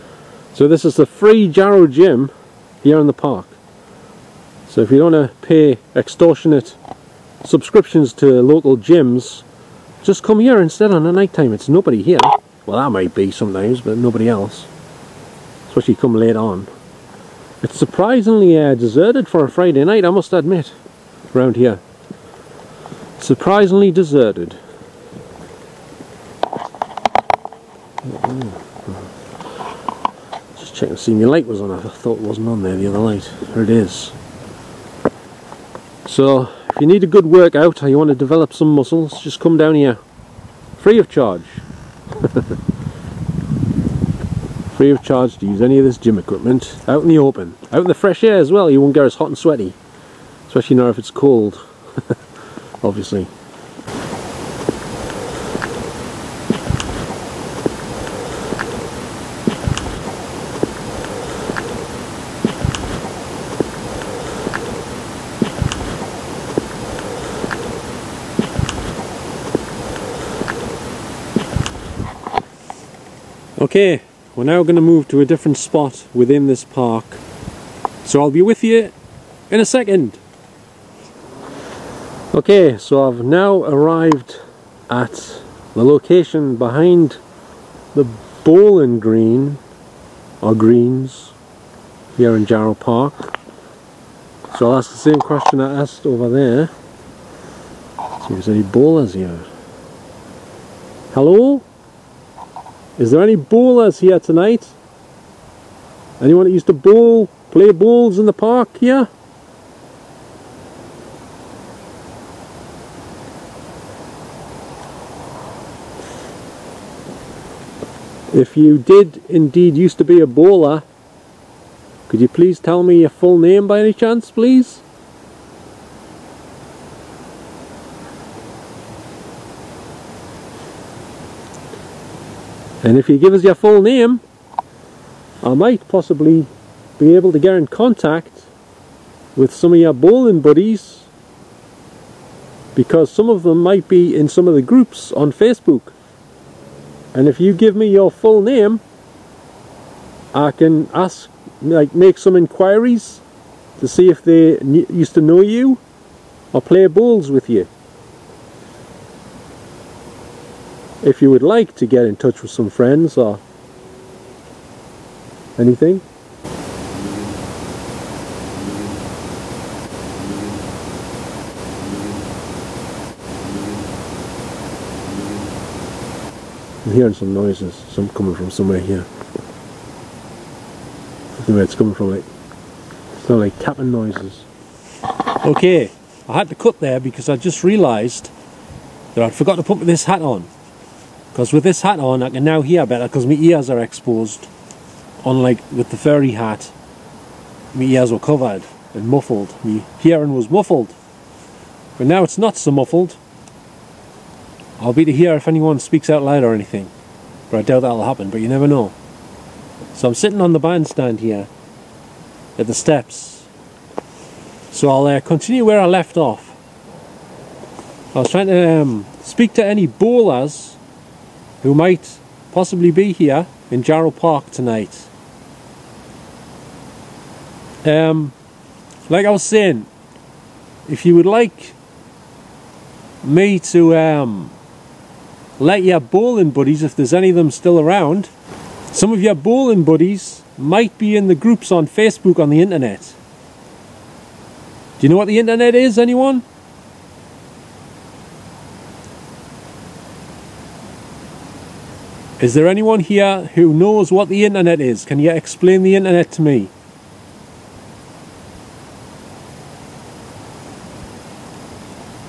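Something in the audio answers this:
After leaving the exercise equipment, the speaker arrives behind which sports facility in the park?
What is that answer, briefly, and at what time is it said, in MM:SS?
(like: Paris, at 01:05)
bowling green, at 01:28.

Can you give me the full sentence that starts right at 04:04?
Do you know what the internet is, anyone?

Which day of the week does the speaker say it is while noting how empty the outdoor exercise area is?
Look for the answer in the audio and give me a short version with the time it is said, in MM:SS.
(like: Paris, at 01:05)
Friday, at 00:19.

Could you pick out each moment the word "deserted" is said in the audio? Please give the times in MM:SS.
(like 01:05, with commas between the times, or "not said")
00:18, 00:23.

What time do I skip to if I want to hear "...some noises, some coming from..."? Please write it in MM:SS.
02:57.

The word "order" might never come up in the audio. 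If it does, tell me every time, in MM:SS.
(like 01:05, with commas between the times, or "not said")
not said.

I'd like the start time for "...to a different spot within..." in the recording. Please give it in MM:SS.
01:15.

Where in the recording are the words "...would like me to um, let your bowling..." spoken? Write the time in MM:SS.
03:51.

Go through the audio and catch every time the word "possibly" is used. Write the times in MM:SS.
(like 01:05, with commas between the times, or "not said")
02:15, 03:42.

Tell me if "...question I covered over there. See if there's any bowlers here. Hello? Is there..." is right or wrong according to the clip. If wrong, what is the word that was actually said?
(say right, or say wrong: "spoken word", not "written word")
wrong: "asked", not "covered".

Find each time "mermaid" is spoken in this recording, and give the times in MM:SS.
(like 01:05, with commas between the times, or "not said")
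not said.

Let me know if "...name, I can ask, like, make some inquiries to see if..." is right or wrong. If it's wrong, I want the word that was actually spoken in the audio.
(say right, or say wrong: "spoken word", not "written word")
right.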